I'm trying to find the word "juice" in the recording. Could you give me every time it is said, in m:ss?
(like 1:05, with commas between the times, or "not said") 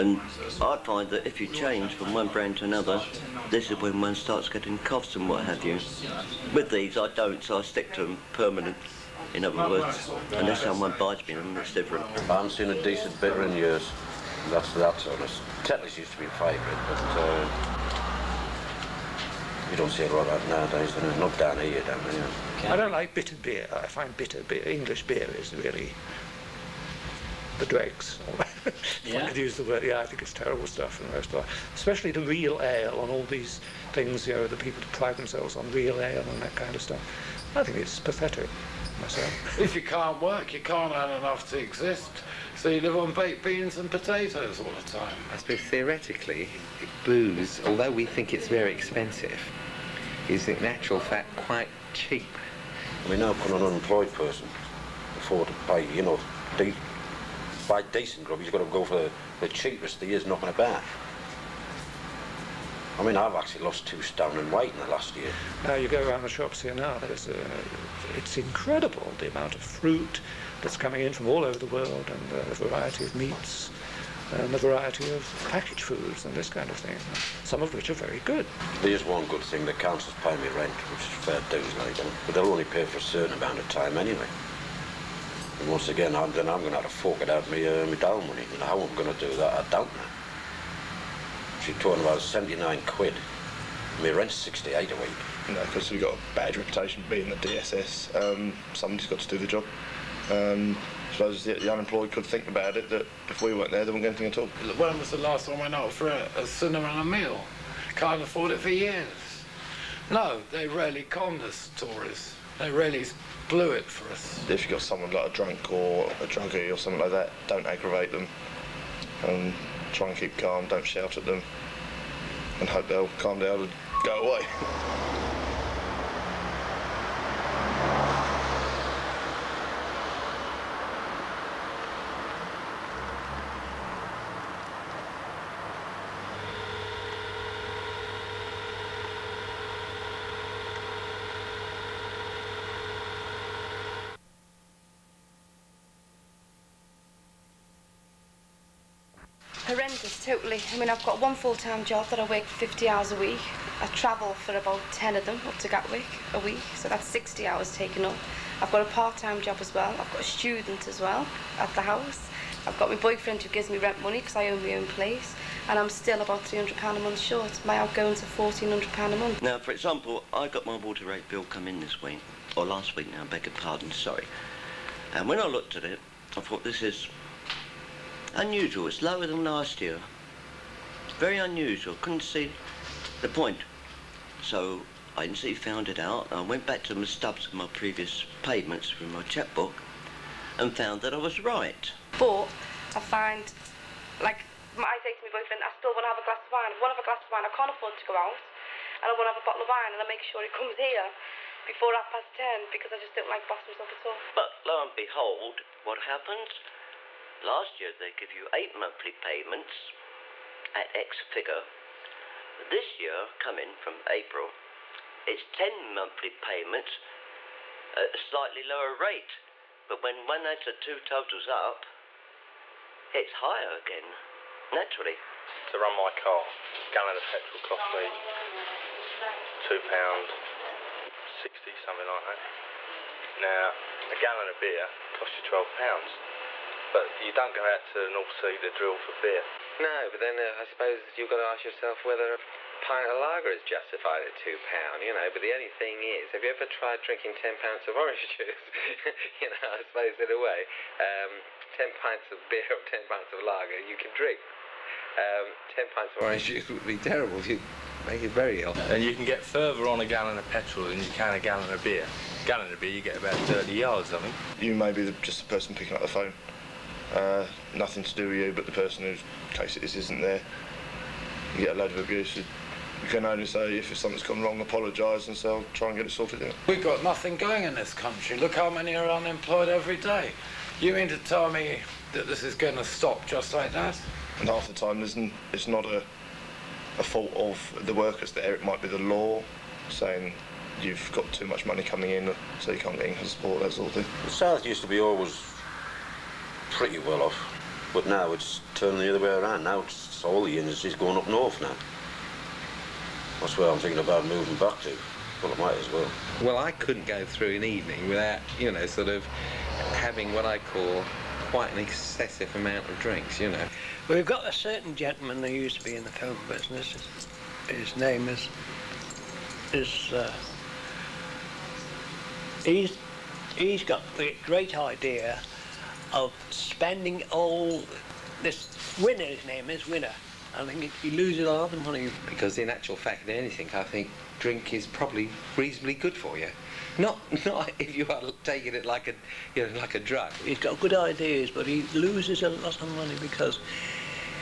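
4:08, 4:16.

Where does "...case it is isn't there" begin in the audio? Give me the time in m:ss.
4:29.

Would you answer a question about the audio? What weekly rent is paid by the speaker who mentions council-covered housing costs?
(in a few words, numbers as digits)
£68.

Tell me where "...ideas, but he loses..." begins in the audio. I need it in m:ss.
5:40.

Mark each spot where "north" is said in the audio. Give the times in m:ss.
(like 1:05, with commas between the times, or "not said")
3:58, 5:01.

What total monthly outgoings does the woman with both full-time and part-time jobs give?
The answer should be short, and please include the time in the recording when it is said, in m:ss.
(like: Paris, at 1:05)
£1,400, at 2:48.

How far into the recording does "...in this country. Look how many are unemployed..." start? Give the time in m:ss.
4:37.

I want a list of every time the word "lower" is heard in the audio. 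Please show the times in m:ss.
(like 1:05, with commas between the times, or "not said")
2:59, 3:38.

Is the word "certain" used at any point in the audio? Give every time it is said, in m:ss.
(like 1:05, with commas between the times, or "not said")
1:23, 5:14.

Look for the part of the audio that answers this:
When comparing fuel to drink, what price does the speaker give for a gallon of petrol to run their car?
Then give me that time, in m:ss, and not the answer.
3:49.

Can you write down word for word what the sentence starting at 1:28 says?
how I'm going to do that, I don't know.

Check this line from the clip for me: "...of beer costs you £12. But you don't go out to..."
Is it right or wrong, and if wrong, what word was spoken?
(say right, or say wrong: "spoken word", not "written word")
right.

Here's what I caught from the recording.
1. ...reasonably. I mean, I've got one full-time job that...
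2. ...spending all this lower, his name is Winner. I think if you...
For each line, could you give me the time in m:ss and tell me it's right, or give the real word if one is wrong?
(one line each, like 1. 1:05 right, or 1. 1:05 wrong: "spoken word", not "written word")
1. 2:30 wrong: "totally", not "reasonably"
2. 5:26 wrong: "winner", not "lower".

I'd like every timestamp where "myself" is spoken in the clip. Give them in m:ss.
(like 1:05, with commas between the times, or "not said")
0:39, 3:23.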